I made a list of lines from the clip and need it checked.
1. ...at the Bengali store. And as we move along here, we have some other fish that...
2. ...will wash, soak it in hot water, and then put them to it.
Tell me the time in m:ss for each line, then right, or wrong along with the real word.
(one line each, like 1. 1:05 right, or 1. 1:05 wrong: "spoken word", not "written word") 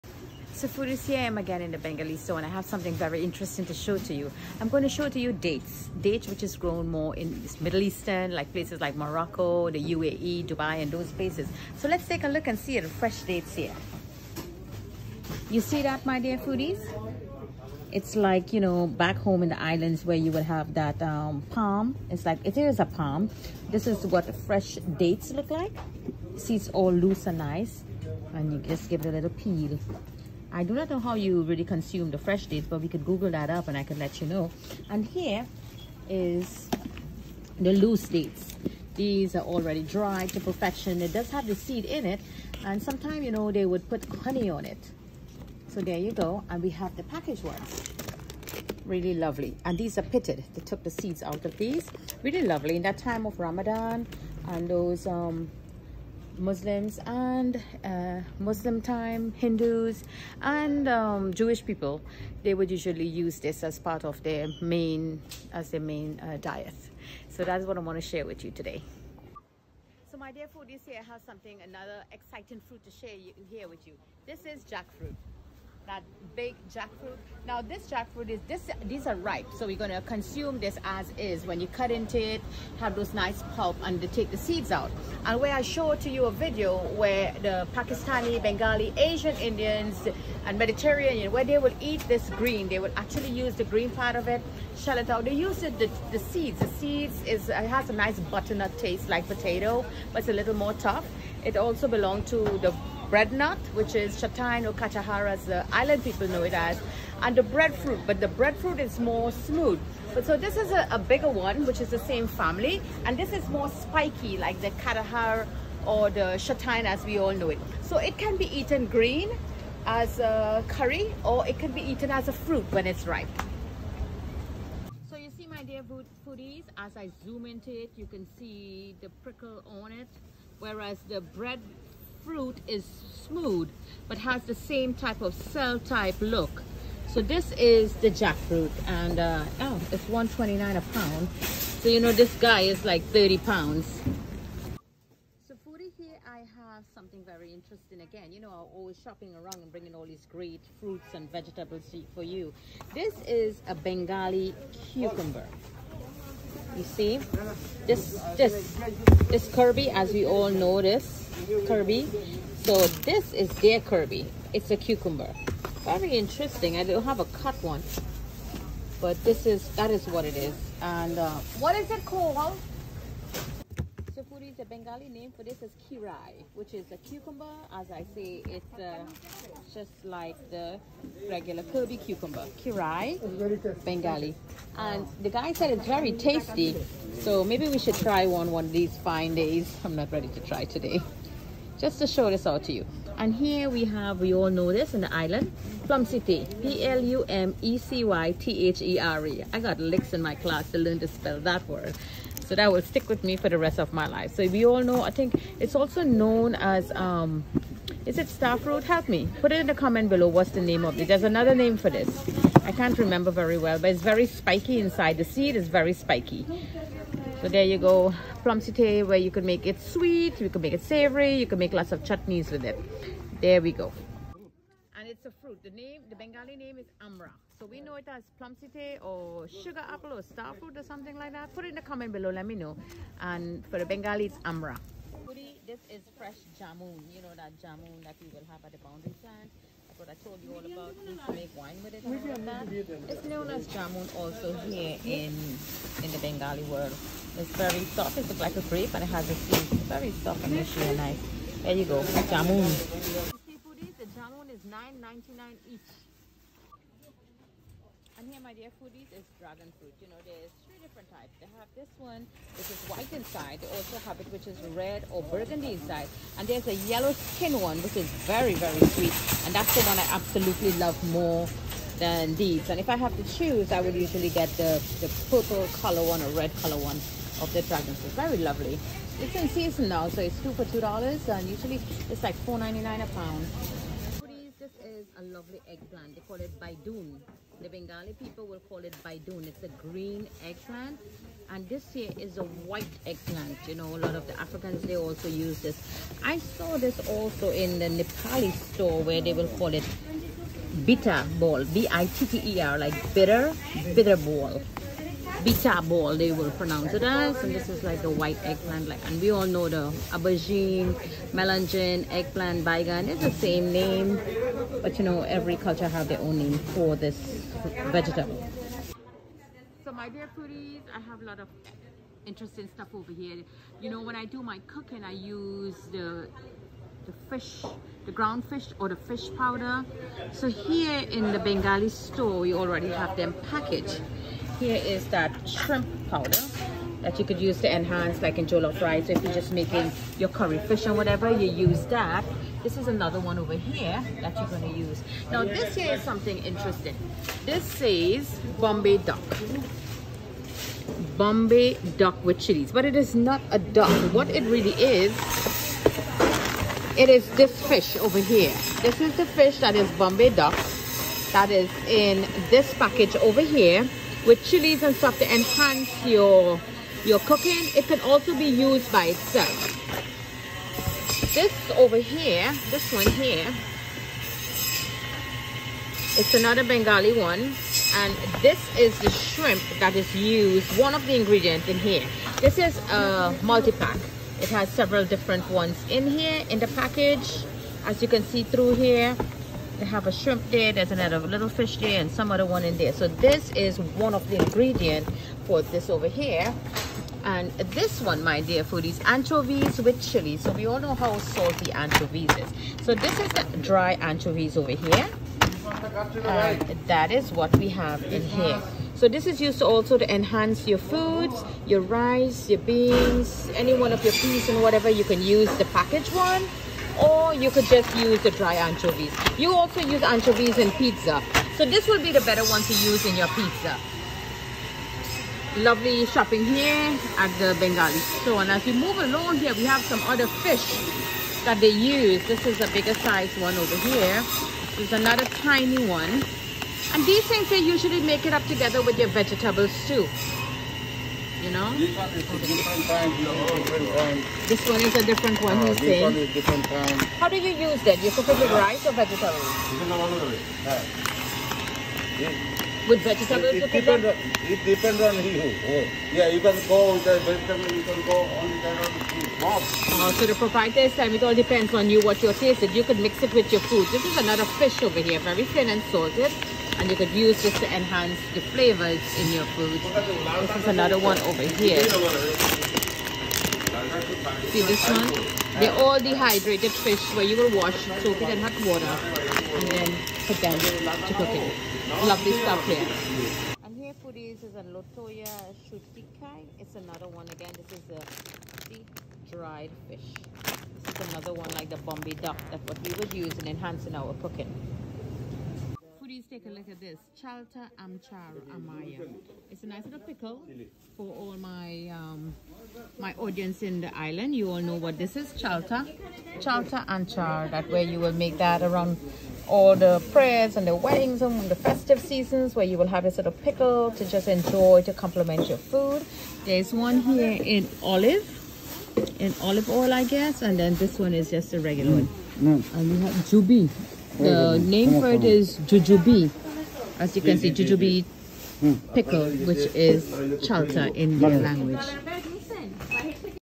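1. 7:07 right
2. 7:57 right.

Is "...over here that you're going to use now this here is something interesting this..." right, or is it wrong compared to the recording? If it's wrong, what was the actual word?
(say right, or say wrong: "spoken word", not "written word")
right.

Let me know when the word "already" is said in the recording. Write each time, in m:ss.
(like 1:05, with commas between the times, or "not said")
0:39, 5:32.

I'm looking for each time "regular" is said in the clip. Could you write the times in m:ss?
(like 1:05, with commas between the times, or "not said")
3:01, 8:41.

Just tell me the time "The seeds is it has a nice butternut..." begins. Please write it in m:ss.
1:36.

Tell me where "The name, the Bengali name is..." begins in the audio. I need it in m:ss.
3:45.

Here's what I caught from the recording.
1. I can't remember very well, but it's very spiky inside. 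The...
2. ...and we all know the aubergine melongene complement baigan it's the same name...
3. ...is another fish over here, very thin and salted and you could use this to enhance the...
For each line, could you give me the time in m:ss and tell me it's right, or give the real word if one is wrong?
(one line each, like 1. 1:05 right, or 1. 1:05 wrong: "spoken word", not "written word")
1. 3:32 right
2. 5:09 wrong: "eggplant", not "complement"
3. 7:44 right.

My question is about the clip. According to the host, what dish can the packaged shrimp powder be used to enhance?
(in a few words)
Jollof rice.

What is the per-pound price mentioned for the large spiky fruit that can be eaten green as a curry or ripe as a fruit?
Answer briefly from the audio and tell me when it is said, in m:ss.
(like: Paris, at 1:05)
$1.29, at 2:20.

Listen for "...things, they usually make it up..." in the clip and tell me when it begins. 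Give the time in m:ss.
7:17.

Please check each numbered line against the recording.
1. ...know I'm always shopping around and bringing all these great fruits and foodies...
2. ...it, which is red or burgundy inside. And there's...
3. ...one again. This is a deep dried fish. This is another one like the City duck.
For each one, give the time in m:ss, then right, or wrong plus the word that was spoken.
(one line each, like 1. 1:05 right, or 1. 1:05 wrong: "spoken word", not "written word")
1. 2:28 wrong: "vegetables", not "foodies"
2. 4:24 right
3. 8:07 wrong: "Bombay", not "City".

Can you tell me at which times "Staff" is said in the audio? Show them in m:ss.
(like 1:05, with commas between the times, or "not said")
3:28.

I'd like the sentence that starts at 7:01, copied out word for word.
So this will be the better one to use in your pizza.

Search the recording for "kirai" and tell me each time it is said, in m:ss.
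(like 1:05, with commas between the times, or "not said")
2:55, 3:02.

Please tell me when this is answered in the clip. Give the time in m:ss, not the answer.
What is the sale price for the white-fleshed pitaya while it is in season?
4:40.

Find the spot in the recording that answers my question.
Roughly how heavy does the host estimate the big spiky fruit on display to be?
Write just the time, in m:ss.
2:23.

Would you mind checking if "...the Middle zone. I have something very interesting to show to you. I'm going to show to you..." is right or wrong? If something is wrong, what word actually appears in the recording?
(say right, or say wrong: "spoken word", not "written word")
wrong: "Bengali", not "Middle".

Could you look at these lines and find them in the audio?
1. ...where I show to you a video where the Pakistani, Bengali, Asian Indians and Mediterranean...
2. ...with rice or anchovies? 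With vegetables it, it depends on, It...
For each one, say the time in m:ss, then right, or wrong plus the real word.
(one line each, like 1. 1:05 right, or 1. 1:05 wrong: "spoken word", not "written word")
1. 1:25 right
2. 7:28 wrong: "vegetables", not "anchovies".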